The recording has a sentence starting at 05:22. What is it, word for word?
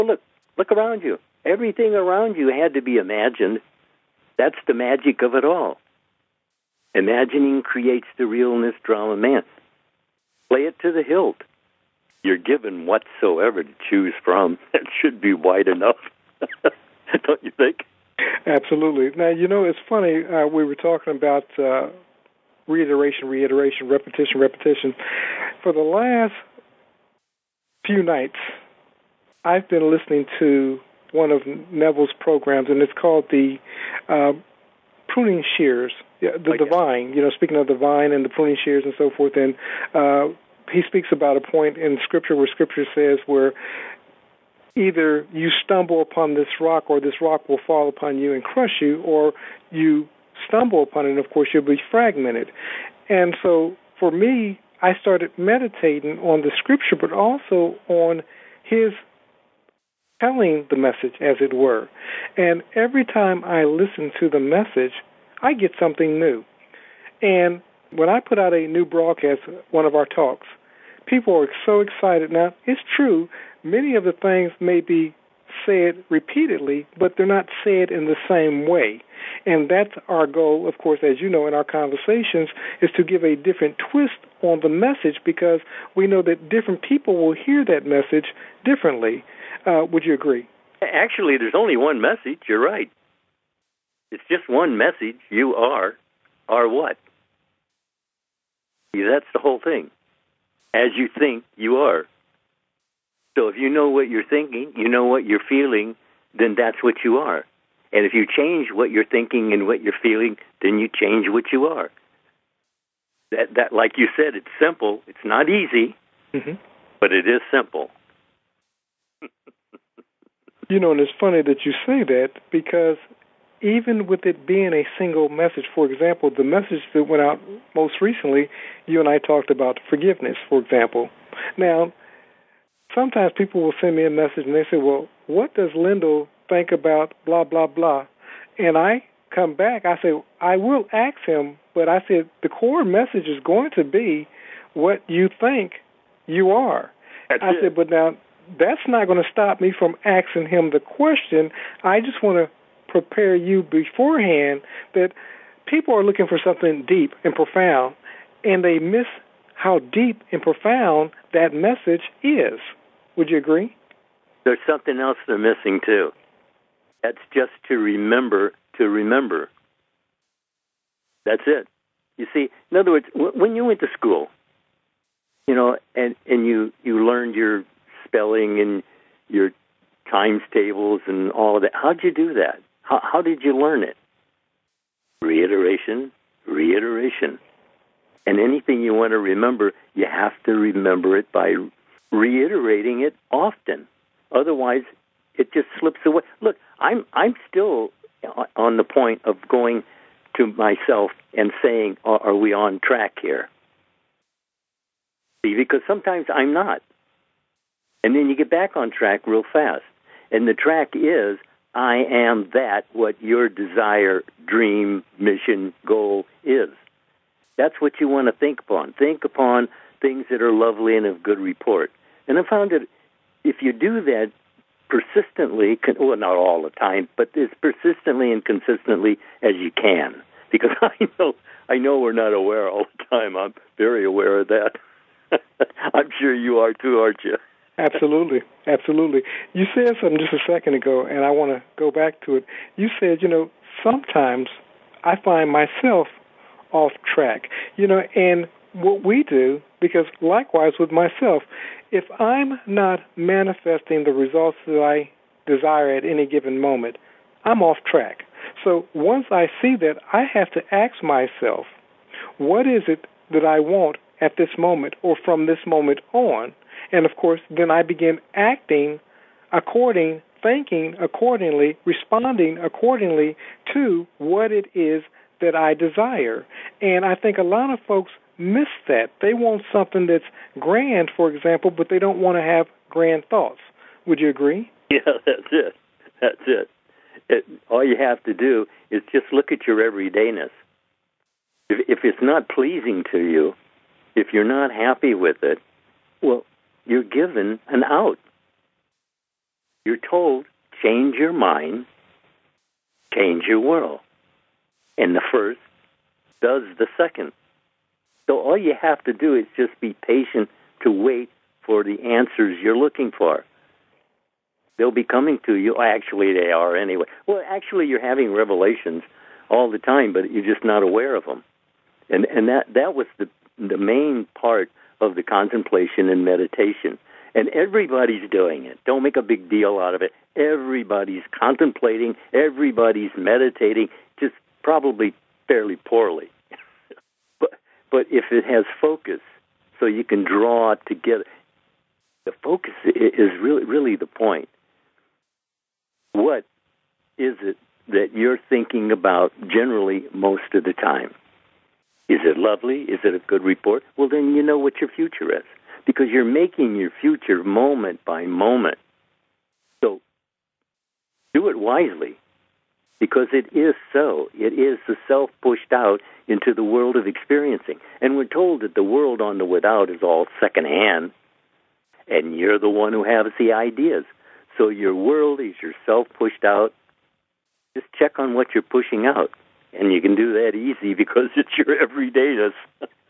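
And and that that was the the main part of the contemplation and meditation.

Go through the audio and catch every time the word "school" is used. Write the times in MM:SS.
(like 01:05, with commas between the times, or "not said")
02:53.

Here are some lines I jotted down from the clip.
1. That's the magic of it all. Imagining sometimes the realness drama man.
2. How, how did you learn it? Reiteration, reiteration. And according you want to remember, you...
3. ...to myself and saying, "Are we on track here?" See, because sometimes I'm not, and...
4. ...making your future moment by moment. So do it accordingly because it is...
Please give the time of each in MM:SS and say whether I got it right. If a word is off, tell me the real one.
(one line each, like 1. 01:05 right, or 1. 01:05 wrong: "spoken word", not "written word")
1. 00:04 wrong: "creates", not "sometimes"
2. 03:02 wrong: "anything", not "according"
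3. 03:20 right
4. 05:56 wrong: "wisely", not "accordingly".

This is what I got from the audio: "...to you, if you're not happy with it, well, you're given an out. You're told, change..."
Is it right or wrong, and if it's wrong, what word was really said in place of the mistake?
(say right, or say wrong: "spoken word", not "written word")
right.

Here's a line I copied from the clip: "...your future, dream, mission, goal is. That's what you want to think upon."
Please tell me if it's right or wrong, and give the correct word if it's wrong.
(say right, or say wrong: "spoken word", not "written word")
wrong: "desire", not "future".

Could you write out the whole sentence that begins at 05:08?
So all you have to do is just be patient to wait for the answers you're looking for.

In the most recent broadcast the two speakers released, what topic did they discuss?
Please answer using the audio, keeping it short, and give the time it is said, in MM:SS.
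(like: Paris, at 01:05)
forgiveness, at 02:09.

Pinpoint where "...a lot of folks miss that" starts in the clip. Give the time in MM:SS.
04:37.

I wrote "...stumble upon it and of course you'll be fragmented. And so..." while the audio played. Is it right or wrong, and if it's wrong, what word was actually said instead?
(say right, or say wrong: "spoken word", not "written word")
right.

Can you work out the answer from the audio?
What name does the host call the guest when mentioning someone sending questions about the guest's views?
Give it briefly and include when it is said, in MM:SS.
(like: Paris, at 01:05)
Lindell, at 02:15.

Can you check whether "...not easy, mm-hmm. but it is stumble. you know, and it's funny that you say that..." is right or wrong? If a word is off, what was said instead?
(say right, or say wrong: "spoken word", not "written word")
wrong: "simple", not "stumble".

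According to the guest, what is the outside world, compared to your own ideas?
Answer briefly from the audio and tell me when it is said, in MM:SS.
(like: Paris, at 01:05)
secondhand, at 06:10.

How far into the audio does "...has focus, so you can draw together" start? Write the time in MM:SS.
05:38.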